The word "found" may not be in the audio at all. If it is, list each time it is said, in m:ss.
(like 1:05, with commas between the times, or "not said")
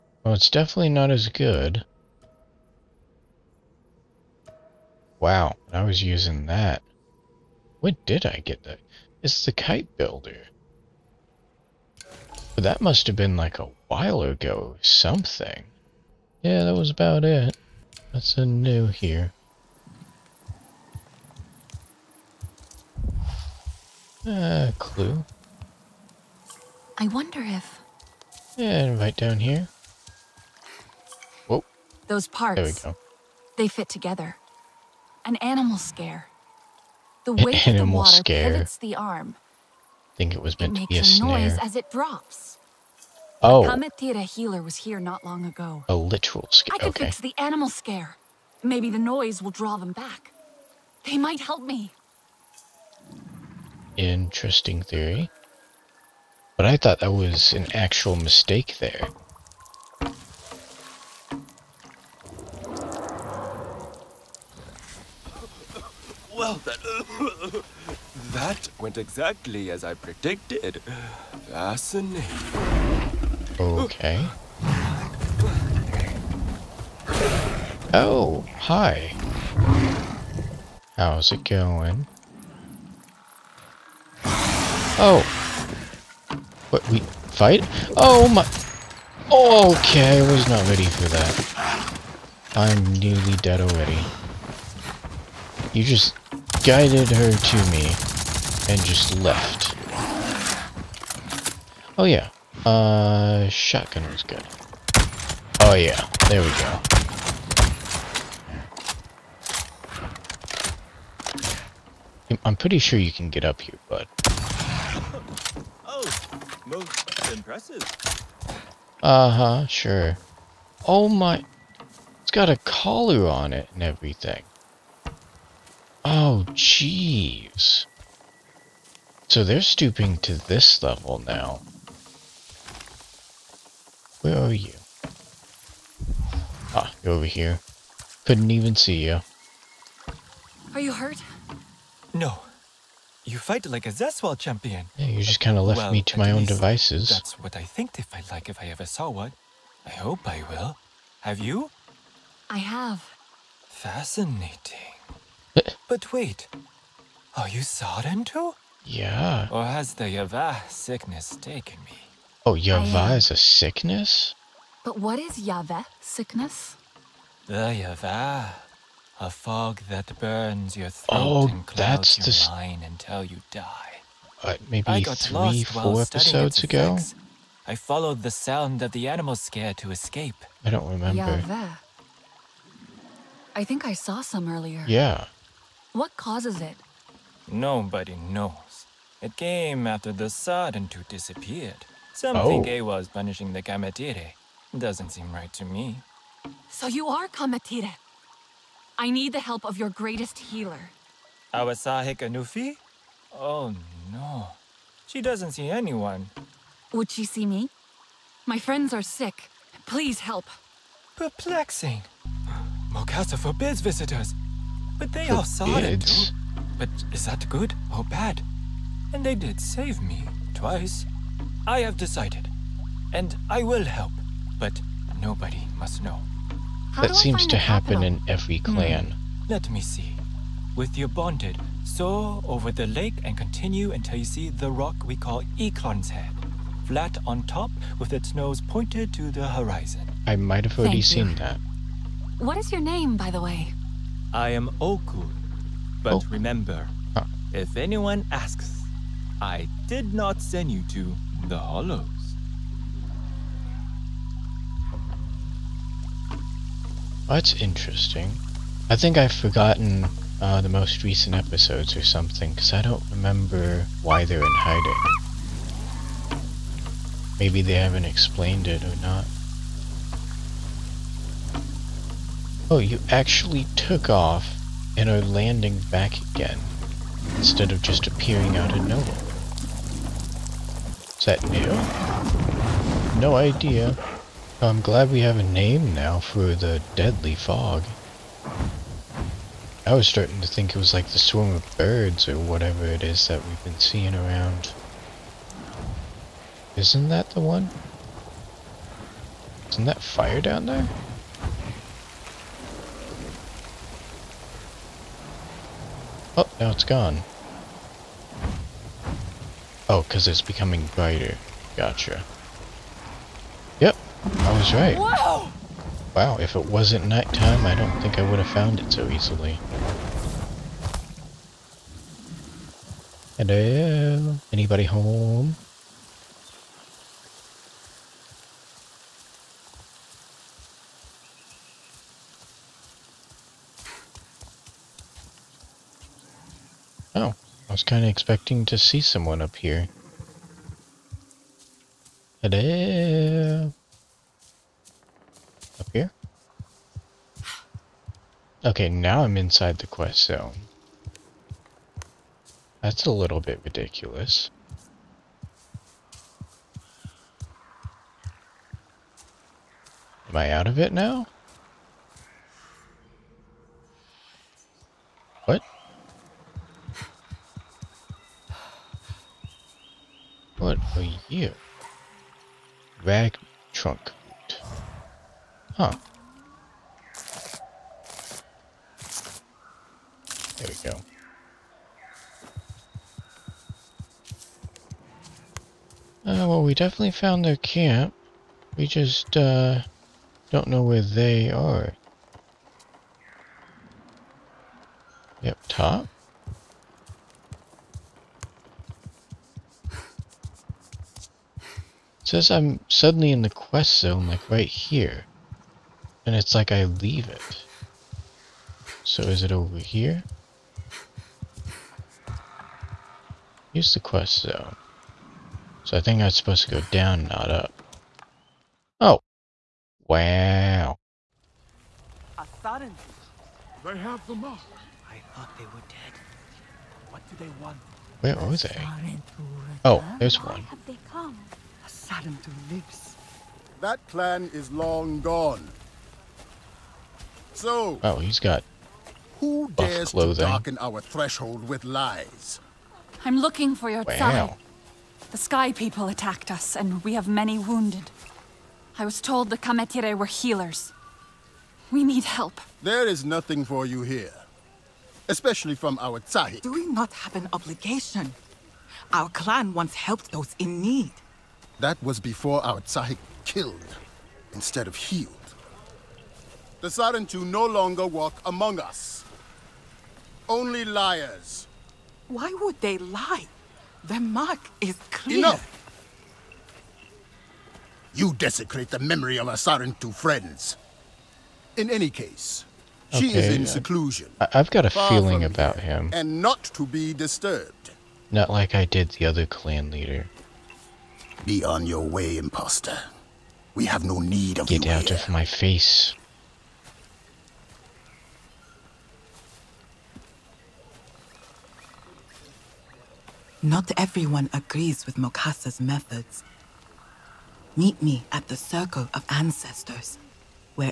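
5:18, 6:27.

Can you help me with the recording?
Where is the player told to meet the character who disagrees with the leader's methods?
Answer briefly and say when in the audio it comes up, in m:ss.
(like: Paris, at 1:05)
Circle of Ancestors, at 8:28.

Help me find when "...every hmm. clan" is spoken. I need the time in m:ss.
3:48.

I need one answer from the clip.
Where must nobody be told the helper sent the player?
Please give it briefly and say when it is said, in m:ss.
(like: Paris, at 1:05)
The Hollows, at 4:11.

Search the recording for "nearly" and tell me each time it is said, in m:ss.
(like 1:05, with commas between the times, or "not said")
1:32.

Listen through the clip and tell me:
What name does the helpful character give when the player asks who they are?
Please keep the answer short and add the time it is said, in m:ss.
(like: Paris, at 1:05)
Oku, at 4:04.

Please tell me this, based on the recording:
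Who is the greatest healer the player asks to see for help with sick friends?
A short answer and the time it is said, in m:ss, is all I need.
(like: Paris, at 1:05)
Awasahe Kanufi, at 3:21.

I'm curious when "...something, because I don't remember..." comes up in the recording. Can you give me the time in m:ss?
4:22.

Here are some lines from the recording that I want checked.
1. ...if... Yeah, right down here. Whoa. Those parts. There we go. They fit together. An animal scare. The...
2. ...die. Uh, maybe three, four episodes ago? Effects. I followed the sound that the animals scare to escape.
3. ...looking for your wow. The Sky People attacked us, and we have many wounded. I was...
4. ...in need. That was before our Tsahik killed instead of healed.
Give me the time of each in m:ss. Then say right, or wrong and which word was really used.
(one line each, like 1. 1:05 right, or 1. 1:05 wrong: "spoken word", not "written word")
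1. 0:27 right
2. 2:53 right
3. 7:23 right
4. 7:40 right.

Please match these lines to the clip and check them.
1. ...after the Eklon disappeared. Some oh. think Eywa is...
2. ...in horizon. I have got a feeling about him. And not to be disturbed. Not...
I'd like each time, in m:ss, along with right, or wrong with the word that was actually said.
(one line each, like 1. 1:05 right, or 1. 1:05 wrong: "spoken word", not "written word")
1. 3:09 wrong: "Sardin", not "Eklon"
2. 8:03 wrong: "seclusion", not "horizon".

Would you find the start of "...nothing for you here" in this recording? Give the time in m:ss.
7:33.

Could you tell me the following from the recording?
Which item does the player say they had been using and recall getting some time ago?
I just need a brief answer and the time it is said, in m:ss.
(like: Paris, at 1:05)
The kite builder, at 0:09.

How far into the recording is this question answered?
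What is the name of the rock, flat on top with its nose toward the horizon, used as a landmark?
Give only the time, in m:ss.
3:55.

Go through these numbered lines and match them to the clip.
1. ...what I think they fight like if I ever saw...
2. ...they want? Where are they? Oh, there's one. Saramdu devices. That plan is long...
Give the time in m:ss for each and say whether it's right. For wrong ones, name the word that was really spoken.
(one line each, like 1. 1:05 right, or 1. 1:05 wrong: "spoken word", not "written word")
1. 2:27 right
2. 7:07 wrong: "lives", not "devices".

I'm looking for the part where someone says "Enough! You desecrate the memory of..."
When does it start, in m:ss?
7:55.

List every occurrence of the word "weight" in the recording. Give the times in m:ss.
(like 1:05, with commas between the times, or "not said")
0:37.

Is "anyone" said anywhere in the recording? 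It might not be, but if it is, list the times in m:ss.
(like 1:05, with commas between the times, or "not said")
3:25, 4:07.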